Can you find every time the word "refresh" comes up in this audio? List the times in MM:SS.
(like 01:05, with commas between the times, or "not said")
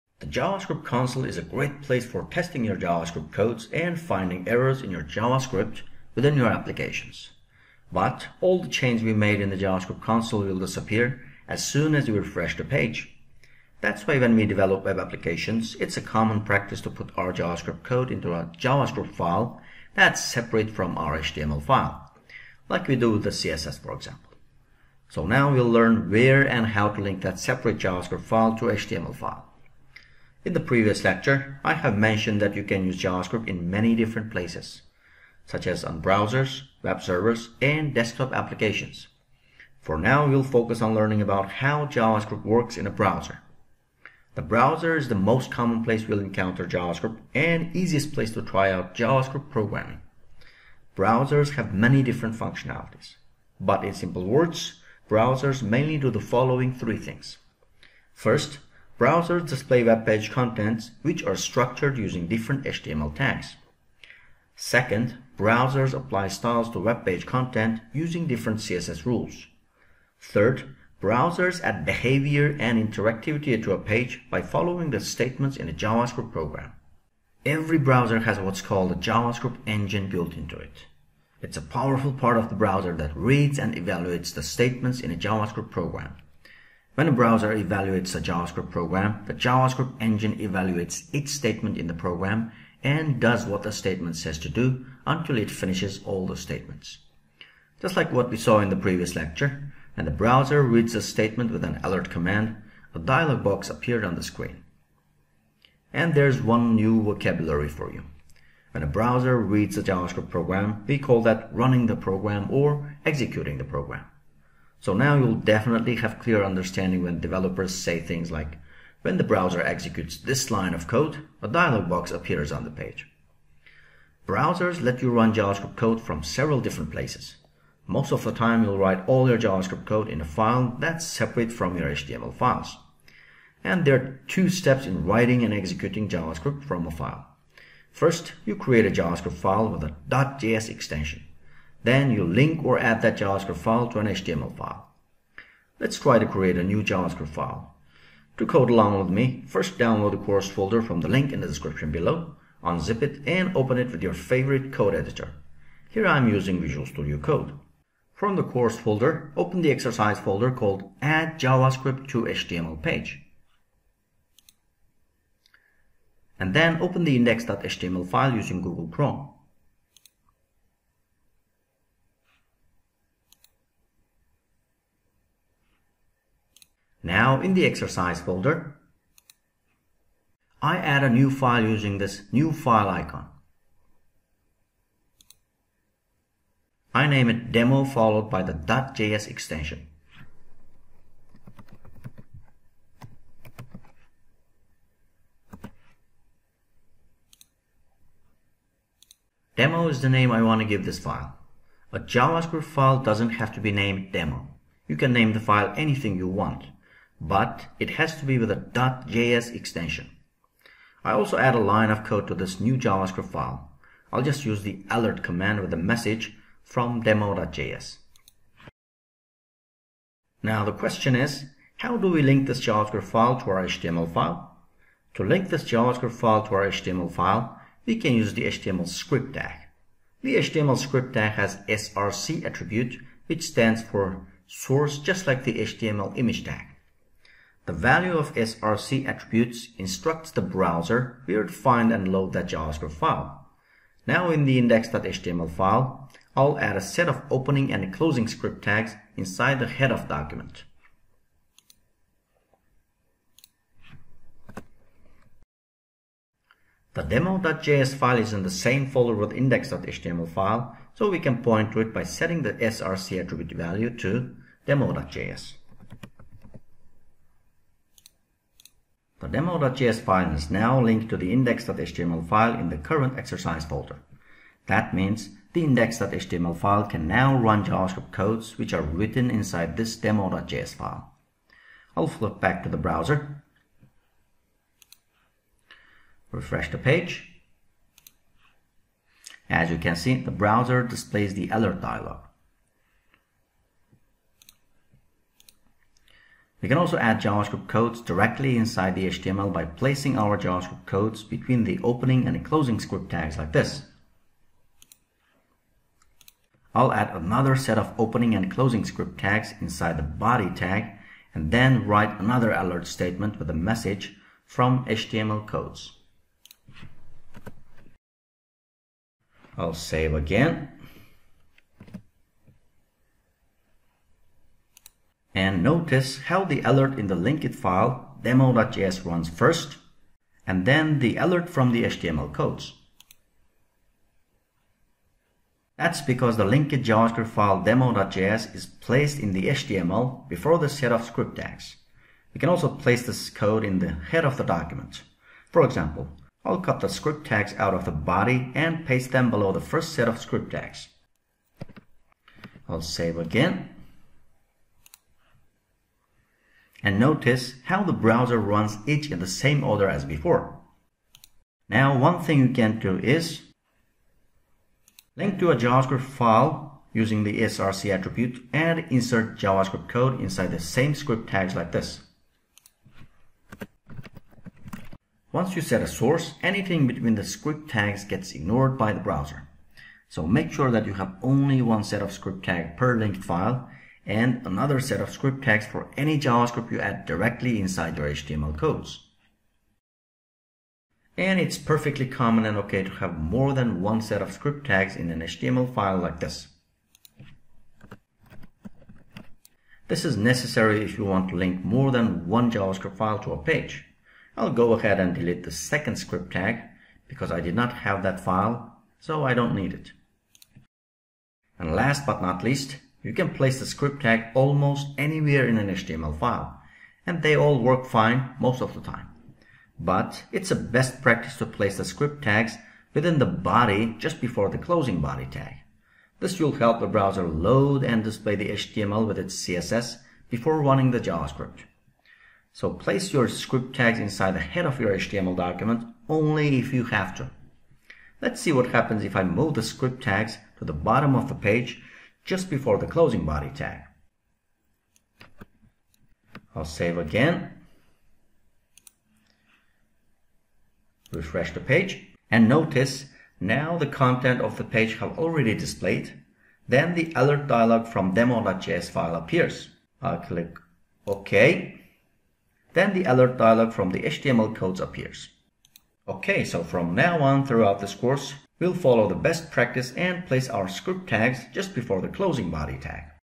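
00:12, 04:46, 07:31.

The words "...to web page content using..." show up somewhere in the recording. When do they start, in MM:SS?
01:06.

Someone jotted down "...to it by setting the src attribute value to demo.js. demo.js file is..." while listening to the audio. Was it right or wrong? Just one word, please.
right.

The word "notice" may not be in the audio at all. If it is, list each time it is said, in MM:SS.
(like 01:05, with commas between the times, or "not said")
05:25, 05:56, 07:32.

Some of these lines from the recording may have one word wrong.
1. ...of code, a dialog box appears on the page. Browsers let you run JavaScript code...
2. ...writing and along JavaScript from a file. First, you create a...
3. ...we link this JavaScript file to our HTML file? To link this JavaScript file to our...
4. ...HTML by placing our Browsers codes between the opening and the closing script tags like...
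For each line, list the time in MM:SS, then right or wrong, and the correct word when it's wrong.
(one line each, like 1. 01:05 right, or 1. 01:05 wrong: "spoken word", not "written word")
1. 02:00 right
2. 02:15 wrong: "executing", not "along"
3. 03:42 right
4. 04:59 wrong: "JavaScript", not "Browsers".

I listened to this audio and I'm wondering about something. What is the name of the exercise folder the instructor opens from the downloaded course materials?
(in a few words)
Add JavaScript to HTML page.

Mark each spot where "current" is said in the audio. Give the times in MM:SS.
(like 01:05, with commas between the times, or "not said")
04:32.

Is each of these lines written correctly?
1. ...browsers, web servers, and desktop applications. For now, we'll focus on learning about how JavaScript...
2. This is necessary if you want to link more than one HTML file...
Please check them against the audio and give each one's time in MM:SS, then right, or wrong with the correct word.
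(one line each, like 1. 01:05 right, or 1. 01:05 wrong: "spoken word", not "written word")
1. 00:36 right
2. 06:39 wrong: "JavaScript", not "HTML".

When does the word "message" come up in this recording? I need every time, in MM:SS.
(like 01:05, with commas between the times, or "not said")
03:35, 05:13.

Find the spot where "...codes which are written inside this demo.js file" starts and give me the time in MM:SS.
04:38.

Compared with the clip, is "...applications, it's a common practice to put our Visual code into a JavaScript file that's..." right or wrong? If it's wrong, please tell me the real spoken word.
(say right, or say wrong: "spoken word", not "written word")
wrong: "JavaScript", not "Visual".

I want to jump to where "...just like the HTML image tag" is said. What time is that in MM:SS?
03:54.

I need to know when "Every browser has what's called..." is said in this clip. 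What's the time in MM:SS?
01:17.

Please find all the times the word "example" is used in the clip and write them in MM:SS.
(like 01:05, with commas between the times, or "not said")
00:23, 05:45.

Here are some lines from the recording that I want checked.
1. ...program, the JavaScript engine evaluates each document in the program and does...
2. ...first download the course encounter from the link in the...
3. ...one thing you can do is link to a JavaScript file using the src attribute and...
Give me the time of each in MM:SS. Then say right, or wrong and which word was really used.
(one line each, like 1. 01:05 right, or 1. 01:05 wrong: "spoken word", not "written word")
1. 01:28 wrong: "statement", not "document"
2. 02:29 wrong: "folder", not "encounter"
3. 06:01 right.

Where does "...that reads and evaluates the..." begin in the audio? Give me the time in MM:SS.
01:22.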